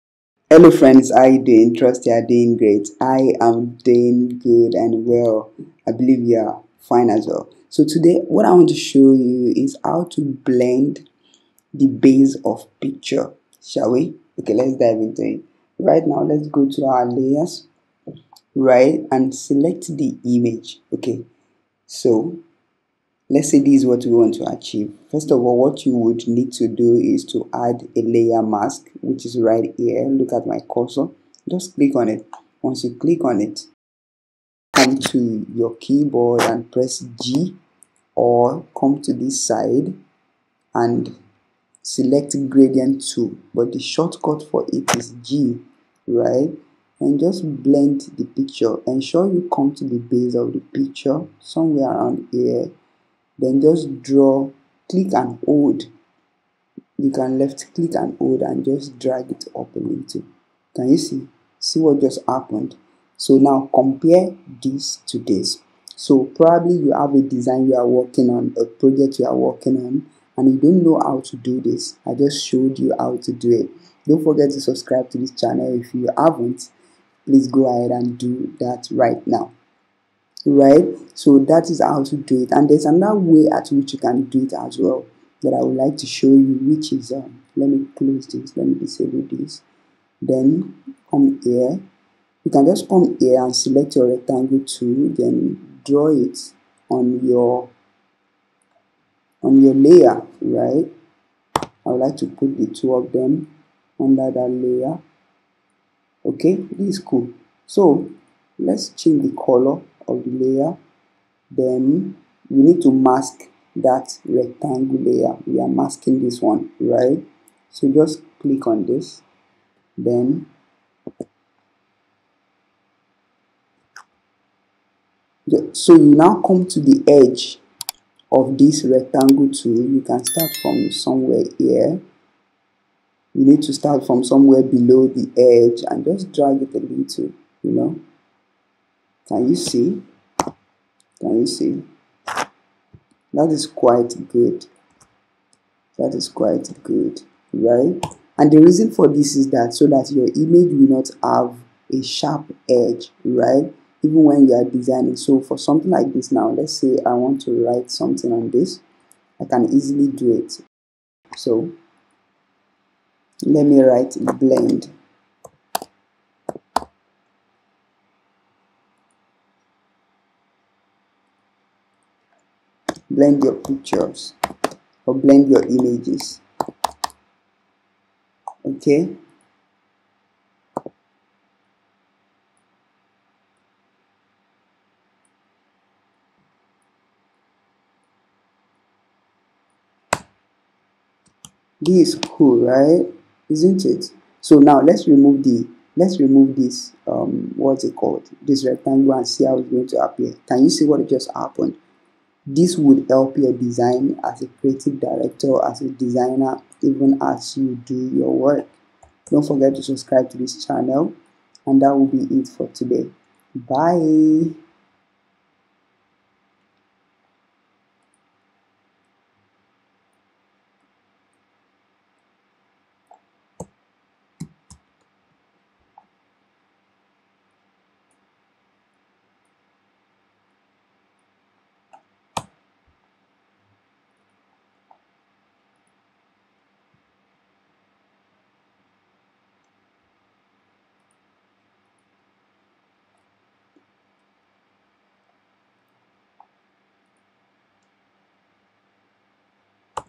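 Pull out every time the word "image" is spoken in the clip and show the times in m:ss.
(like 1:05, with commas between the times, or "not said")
0:20, 2:30, 2:55.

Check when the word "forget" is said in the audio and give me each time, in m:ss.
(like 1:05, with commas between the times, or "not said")
1:14, 3:29.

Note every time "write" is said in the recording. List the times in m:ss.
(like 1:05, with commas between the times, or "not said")
2:37, 2:43.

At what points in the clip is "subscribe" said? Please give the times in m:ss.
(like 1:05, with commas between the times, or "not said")
1:14, 3:29.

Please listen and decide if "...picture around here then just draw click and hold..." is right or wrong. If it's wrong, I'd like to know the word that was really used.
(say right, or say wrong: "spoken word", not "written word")
wrong: "somewhere", not "picture".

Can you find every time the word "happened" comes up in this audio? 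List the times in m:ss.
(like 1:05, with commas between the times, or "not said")
1:02, 3:21.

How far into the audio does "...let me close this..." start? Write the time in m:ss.
1:27.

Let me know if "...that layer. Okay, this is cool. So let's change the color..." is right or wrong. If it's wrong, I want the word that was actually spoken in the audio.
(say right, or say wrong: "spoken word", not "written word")
right.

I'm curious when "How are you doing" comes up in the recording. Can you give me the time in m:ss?
0:01.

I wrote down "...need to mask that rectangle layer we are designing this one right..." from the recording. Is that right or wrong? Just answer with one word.
wrong.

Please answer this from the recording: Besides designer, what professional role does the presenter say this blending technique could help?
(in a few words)
creative director.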